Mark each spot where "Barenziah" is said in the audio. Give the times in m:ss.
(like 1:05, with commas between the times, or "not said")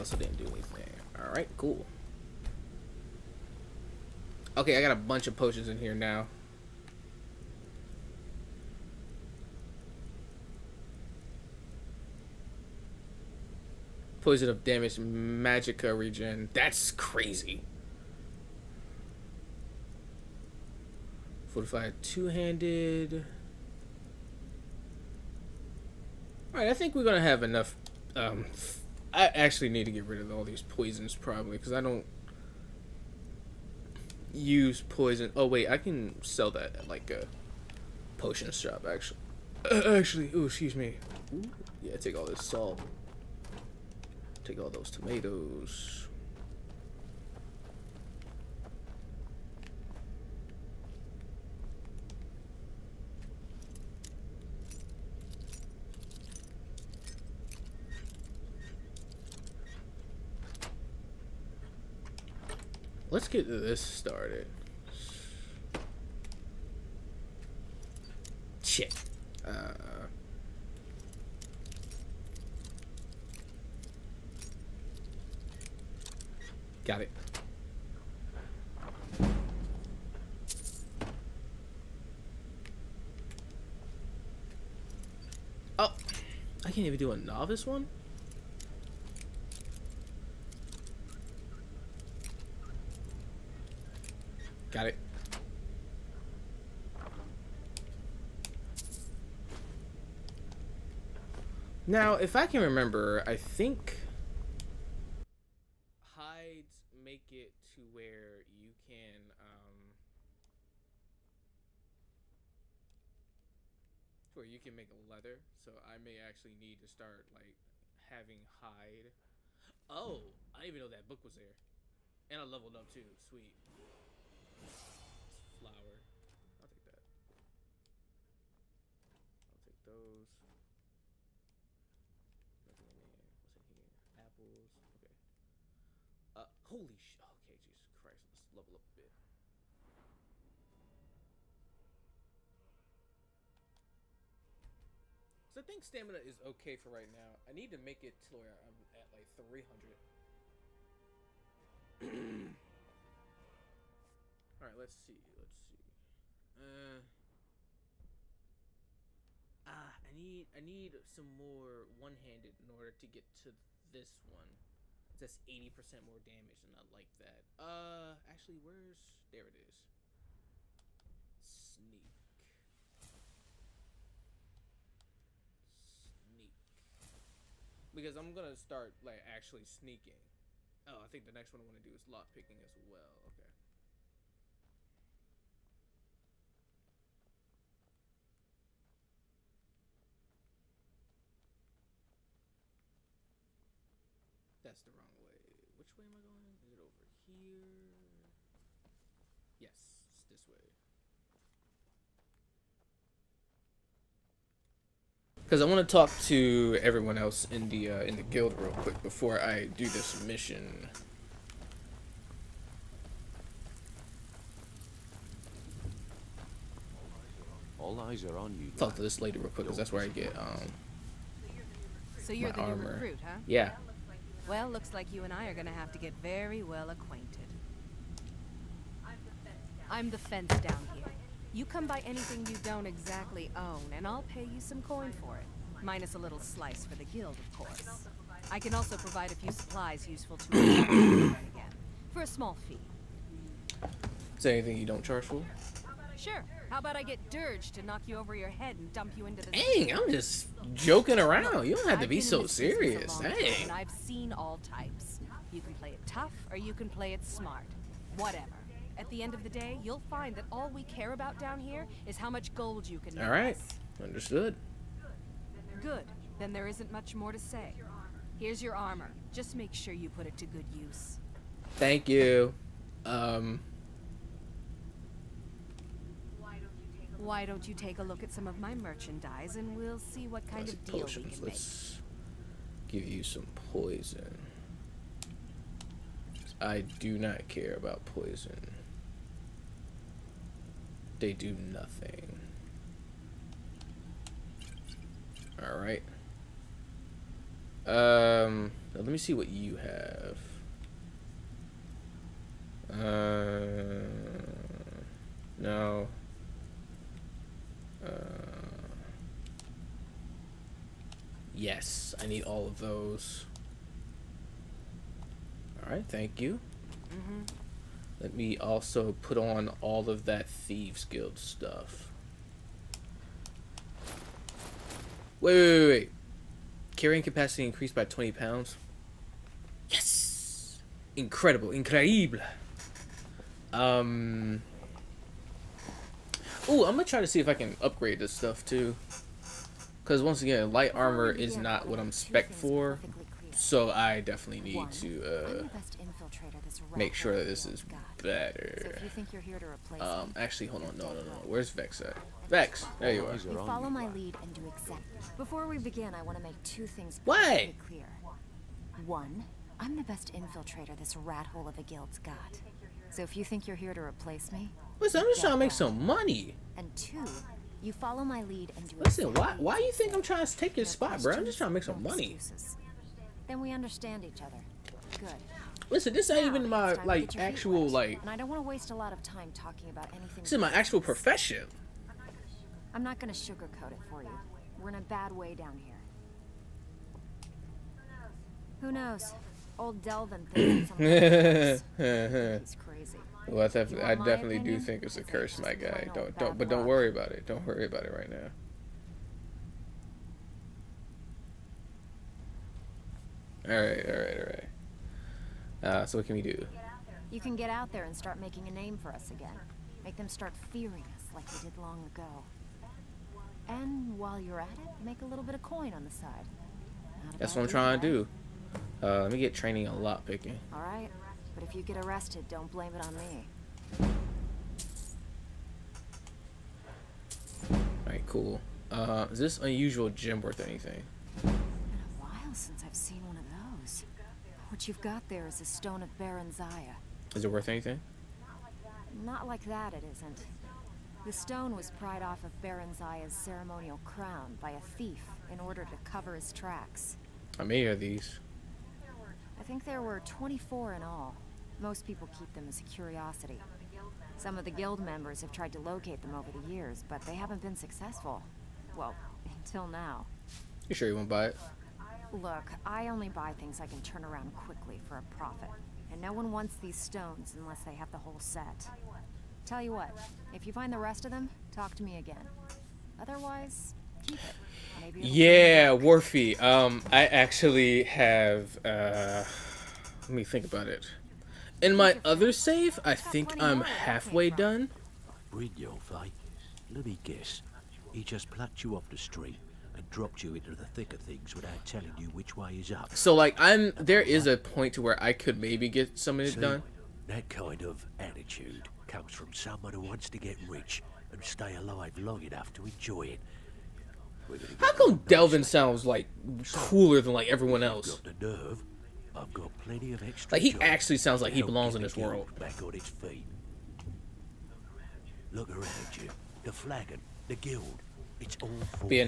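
7:16, 7:22.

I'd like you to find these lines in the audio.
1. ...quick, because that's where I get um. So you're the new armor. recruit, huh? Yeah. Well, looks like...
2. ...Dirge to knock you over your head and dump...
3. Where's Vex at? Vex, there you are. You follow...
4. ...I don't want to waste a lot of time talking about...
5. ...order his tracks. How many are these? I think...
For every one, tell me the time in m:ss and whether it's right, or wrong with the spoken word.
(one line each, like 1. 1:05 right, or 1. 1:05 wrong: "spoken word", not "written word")
1. 3:39 right
2. 4:07 right
3. 5:51 right
4. 6:18 right
5. 7:26 wrong: "cover", not "order".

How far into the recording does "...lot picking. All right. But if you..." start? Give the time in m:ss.
6:59.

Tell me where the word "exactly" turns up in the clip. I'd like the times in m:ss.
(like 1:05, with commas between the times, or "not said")
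3:52, 5:54.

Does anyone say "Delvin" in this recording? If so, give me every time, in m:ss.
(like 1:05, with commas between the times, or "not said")
6:30, 8:25.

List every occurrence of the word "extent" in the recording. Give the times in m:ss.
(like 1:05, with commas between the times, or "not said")
not said.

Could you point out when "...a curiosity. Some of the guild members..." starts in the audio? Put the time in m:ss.
7:32.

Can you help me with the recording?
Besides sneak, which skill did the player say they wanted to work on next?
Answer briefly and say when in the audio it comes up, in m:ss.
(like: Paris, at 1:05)
Lock picking, at 3:02.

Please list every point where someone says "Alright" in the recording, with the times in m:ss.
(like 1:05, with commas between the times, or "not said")
0:01, 0:26, 2:34, 4:55, 7:08.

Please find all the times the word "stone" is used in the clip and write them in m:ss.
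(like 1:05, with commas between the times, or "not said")
7:15, 7:21, 7:46.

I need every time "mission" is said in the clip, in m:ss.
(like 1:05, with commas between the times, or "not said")
3:30.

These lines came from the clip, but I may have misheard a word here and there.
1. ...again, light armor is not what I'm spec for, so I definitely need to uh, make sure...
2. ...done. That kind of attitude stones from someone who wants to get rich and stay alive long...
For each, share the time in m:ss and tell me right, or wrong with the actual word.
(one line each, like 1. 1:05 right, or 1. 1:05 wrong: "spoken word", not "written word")
1. 5:40 right
2. 8:16 wrong: "comes", not "stones".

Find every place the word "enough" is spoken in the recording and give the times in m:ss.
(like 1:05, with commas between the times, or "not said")
0:27, 8:22.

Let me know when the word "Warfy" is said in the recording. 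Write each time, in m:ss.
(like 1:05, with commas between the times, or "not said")
7:55.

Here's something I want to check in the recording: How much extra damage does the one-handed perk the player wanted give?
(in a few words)
80% more damage.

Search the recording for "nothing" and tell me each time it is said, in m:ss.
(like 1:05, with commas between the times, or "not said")
2:12, 4:51.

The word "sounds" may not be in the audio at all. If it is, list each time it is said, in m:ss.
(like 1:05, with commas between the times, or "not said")
8:25, 8:31.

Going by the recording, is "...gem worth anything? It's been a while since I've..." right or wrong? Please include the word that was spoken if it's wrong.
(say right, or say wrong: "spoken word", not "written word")
right.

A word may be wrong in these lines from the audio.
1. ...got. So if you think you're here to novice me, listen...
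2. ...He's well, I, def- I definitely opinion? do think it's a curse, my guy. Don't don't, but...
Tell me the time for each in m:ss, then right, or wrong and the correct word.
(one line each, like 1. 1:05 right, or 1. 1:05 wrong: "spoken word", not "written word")
1. 6:02 wrong: "replace", not "novice"
2. 6:31 right.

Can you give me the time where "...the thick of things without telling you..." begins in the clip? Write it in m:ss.
8:10.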